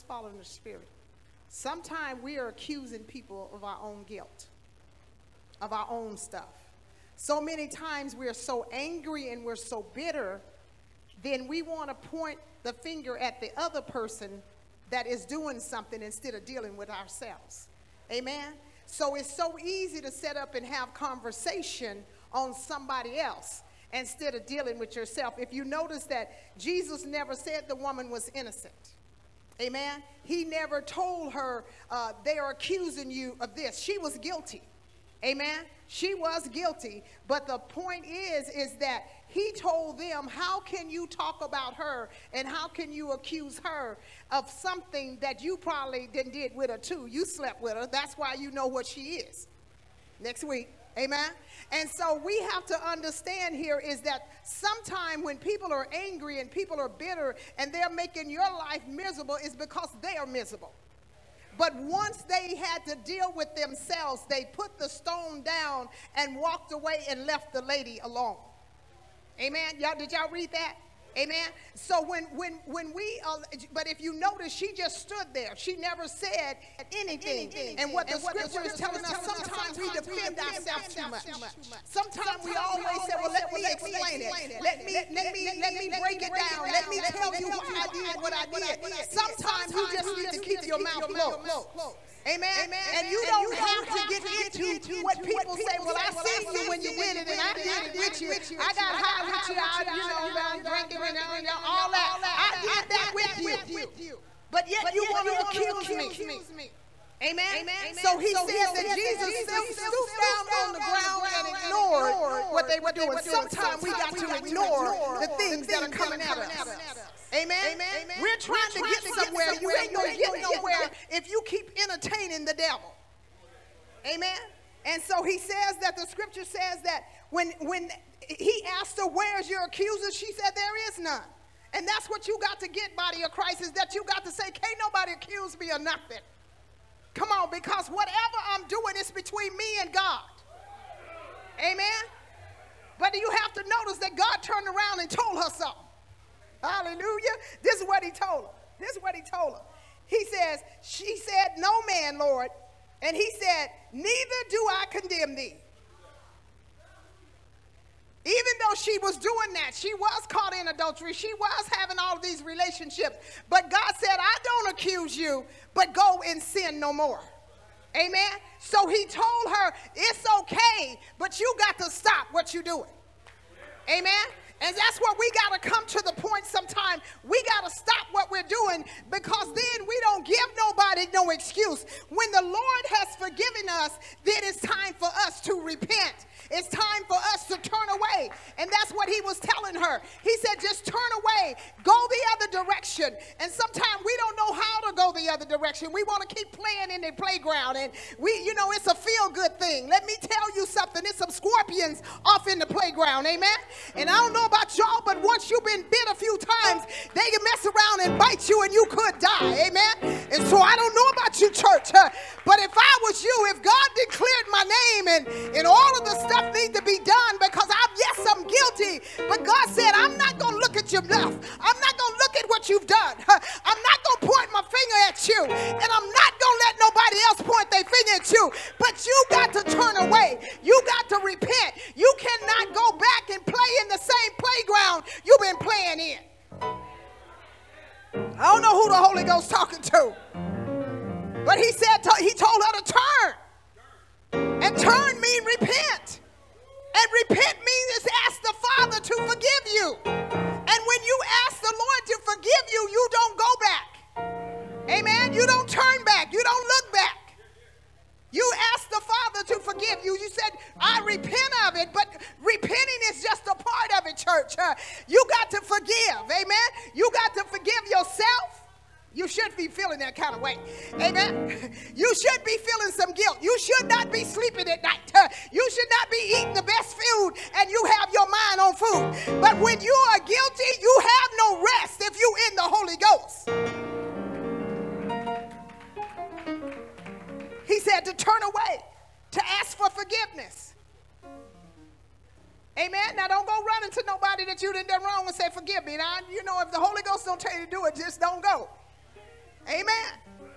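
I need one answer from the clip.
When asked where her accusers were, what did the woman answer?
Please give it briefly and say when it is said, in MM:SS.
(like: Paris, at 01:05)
There is none, at 02:10.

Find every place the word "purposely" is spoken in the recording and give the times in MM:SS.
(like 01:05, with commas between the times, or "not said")
not said.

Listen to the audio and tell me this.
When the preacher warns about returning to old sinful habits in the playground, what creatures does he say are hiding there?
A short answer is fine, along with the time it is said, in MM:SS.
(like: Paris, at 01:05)
Scorpions, at 03:21.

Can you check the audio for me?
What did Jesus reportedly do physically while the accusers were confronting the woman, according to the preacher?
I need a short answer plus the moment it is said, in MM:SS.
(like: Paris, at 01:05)
Stooped down on the ground, at 01:49.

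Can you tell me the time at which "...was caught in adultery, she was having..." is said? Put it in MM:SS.
02:39.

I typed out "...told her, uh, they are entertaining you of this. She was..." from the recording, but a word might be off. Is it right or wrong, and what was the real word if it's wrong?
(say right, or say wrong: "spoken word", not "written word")
wrong: "accusing", not "entertaining".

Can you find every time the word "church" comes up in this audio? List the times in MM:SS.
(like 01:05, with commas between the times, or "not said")
03:31, 04:24.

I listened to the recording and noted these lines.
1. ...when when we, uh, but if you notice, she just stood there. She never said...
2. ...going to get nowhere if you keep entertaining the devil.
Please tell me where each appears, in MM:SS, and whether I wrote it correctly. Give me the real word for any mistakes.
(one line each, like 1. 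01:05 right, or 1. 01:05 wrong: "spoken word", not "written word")
1. 01:12 right
2. 01:59 right.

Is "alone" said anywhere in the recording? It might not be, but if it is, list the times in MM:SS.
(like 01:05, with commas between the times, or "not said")
01:08.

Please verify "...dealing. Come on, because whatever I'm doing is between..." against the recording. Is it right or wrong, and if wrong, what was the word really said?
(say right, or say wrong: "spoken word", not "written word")
wrong: "nothing", not "dealing".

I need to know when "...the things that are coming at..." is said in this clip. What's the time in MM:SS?
01:55.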